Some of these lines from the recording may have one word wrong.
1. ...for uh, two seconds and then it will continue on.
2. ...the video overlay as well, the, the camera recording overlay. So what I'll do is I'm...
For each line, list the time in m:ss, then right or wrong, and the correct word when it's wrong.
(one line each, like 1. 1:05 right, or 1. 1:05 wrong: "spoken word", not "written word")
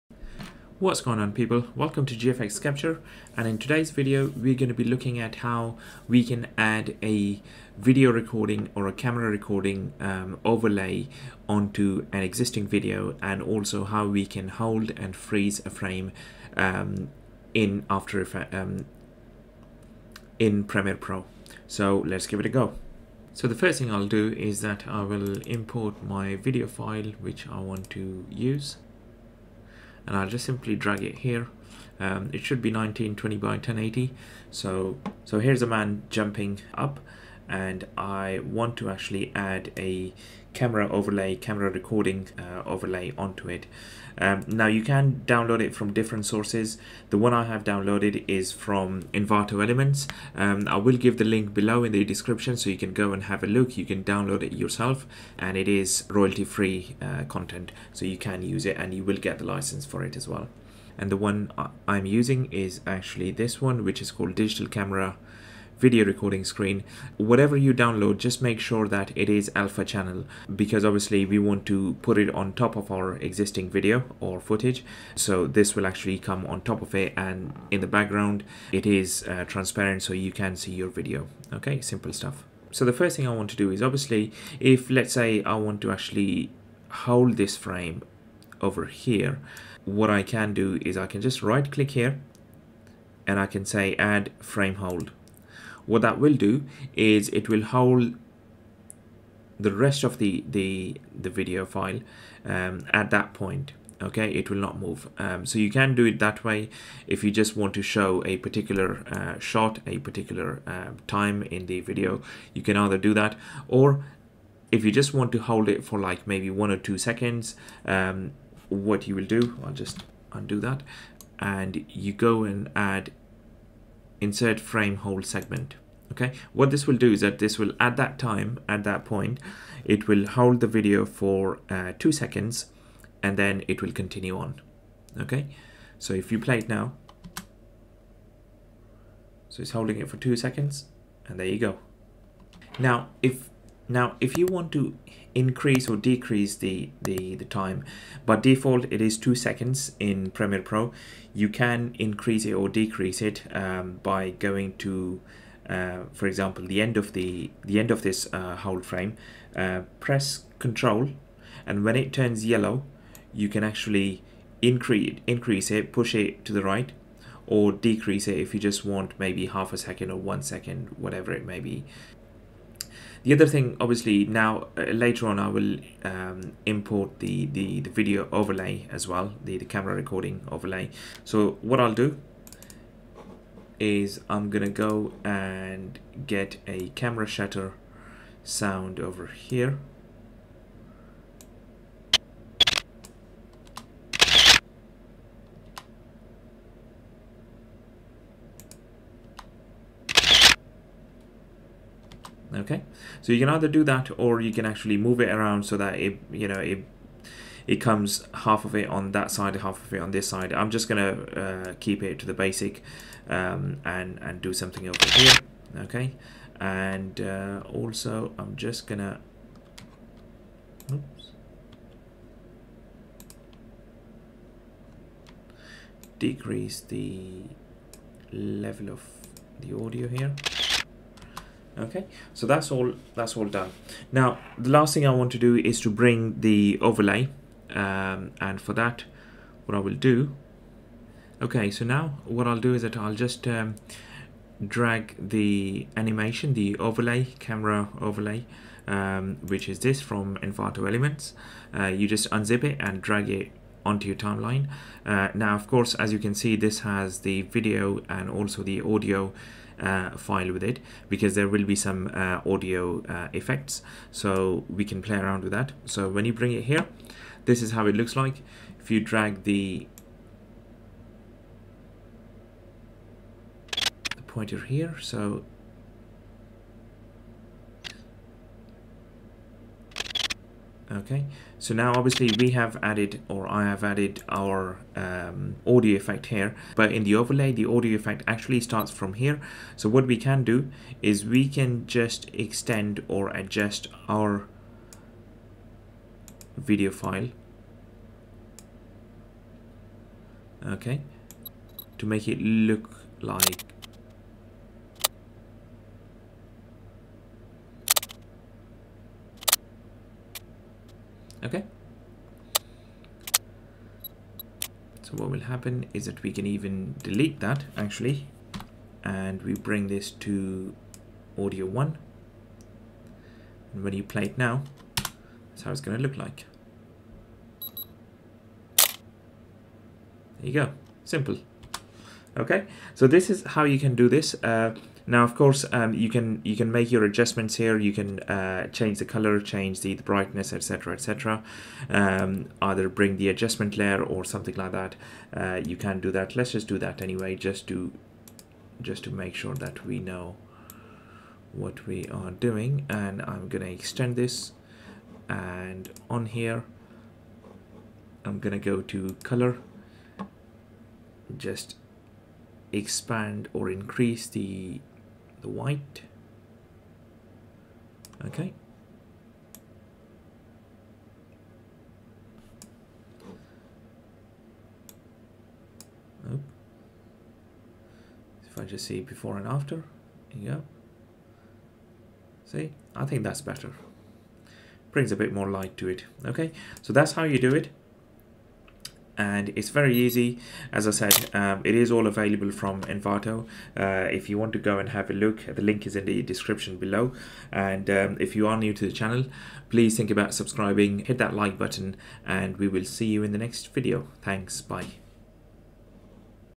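1. 2:11 right
2. 2:57 right.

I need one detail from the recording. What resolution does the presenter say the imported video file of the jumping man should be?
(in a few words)
1920 by 1080.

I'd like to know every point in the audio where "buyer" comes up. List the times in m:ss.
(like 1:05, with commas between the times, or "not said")
not said.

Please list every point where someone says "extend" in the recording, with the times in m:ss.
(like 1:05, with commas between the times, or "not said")
4:52, 5:53.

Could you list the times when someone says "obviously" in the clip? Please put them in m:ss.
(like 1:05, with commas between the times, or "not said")
1:10, 1:23, 2:53, 4:41.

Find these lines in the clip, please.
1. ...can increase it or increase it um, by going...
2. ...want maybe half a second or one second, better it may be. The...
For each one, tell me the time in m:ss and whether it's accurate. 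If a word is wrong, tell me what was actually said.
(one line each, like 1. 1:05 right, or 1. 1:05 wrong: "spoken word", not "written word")
1. 2:31 wrong: "decrease", not "increase"
2. 2:48 wrong: "whatever", not "better".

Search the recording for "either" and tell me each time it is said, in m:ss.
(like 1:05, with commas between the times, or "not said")
1:52, 3:23, 5:42.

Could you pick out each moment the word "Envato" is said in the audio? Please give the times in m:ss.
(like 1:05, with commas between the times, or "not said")
0:49, 4:10, 6:32.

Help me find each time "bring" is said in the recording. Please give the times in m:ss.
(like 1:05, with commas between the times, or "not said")
3:55, 4:26, 5:19, 5:42, 6:24.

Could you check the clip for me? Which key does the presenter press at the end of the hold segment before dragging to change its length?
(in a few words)
Control.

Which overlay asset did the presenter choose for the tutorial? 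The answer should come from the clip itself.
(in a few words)
Digital Camera video recording screen.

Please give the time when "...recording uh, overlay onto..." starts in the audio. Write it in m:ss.
0:41.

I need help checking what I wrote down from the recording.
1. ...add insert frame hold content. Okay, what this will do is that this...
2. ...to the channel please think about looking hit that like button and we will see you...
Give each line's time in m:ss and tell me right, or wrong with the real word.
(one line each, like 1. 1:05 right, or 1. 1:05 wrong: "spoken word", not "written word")
1. 2:02 wrong: "segment", not "content"
2. 6:38 wrong: "subscribing", not "looking".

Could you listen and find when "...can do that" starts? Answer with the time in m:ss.
5:45.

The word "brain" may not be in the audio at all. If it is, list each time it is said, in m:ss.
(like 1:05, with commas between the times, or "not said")
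not said.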